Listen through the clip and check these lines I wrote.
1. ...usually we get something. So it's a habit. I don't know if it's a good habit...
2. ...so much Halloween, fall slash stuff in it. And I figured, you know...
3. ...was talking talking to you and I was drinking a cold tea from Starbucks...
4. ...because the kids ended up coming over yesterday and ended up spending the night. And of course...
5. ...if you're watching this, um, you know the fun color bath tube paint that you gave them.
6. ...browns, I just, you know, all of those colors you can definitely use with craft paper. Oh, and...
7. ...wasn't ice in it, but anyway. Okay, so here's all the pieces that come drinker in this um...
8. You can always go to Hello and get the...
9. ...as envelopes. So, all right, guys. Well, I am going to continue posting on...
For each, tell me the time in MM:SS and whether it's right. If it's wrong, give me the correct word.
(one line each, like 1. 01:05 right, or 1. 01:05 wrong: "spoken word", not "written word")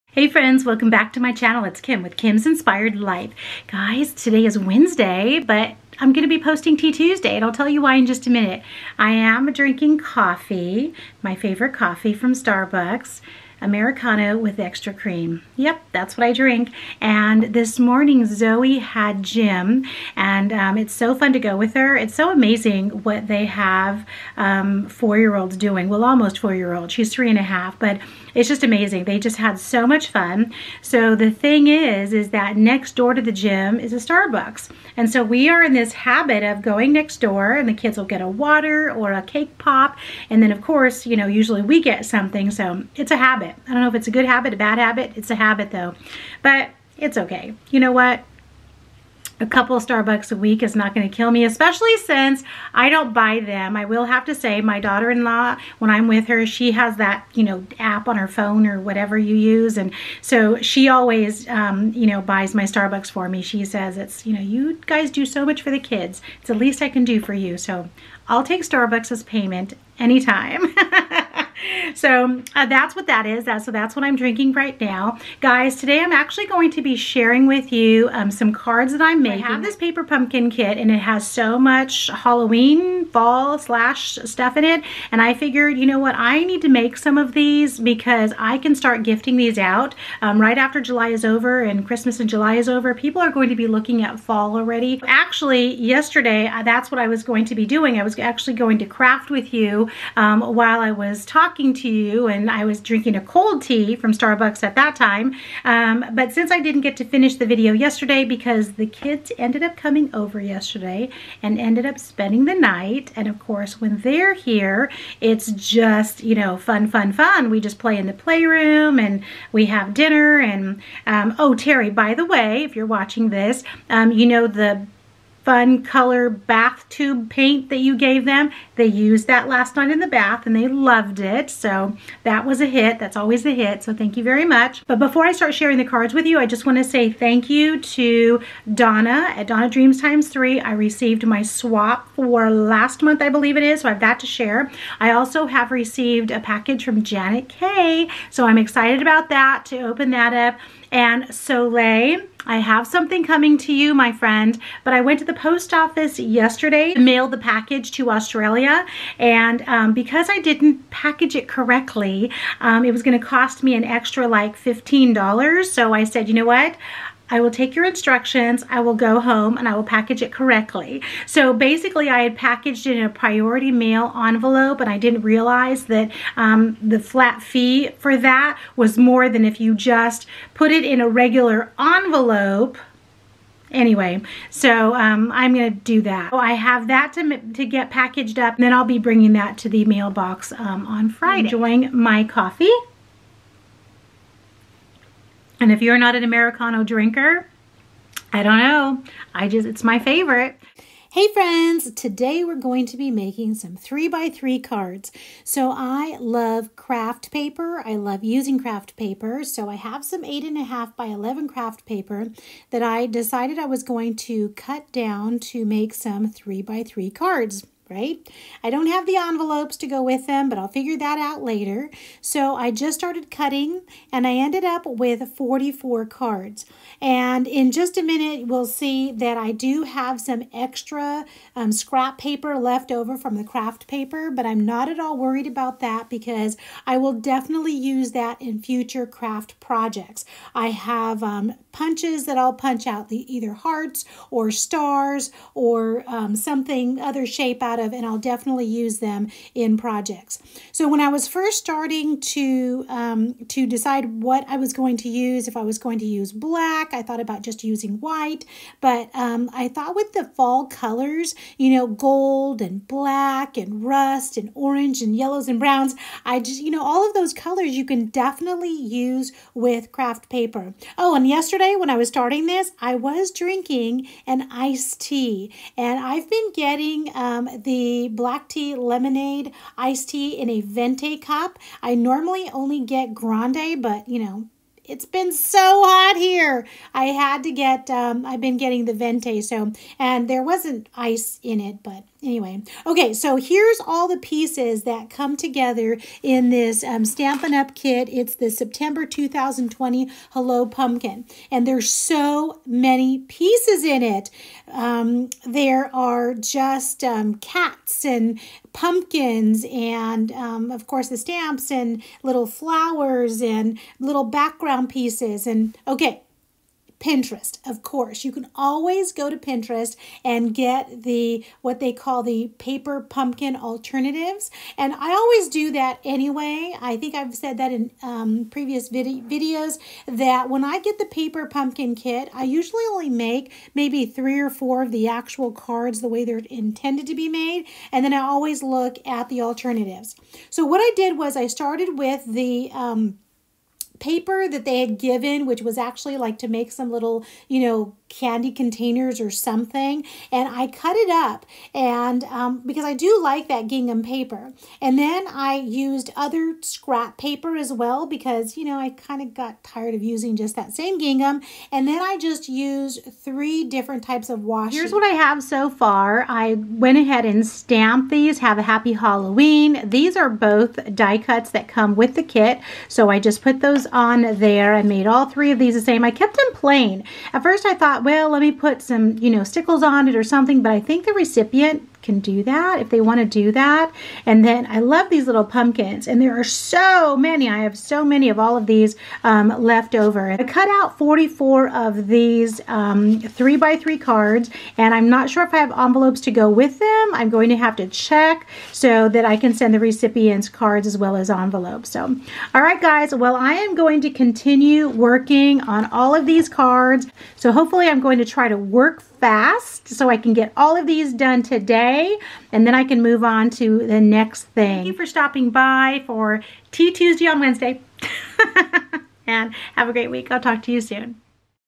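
1. 00:41 right
2. 01:21 right
3. 01:40 right
4. 01:48 right
5. 02:02 right
6. 04:25 right
7. 04:50 wrong: "together", not "drinker"
8. 05:18 wrong: "Pinterest", not "Hello"
9. 06:41 wrong: "working", not "posting".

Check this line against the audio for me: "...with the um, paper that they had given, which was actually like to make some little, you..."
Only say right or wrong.
right.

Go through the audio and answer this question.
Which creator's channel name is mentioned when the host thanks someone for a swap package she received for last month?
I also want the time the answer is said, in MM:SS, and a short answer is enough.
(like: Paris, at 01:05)
Donna Dreams Times 3, at 02:19.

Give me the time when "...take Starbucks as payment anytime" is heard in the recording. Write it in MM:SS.
01:08.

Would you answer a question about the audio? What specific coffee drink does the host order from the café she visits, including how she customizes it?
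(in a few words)
Americano with extra cream.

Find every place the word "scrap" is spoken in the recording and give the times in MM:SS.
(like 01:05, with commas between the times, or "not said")
03:51, 05:56.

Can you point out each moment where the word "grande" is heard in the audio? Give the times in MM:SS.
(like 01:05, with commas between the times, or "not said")
04:43.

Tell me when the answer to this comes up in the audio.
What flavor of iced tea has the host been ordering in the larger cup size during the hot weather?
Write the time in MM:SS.
04:38.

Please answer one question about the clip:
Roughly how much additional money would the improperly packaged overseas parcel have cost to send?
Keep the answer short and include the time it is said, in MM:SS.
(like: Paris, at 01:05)
$15, at 02:44.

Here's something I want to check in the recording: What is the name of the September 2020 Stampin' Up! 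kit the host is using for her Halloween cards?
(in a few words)
Hello Pumpkin.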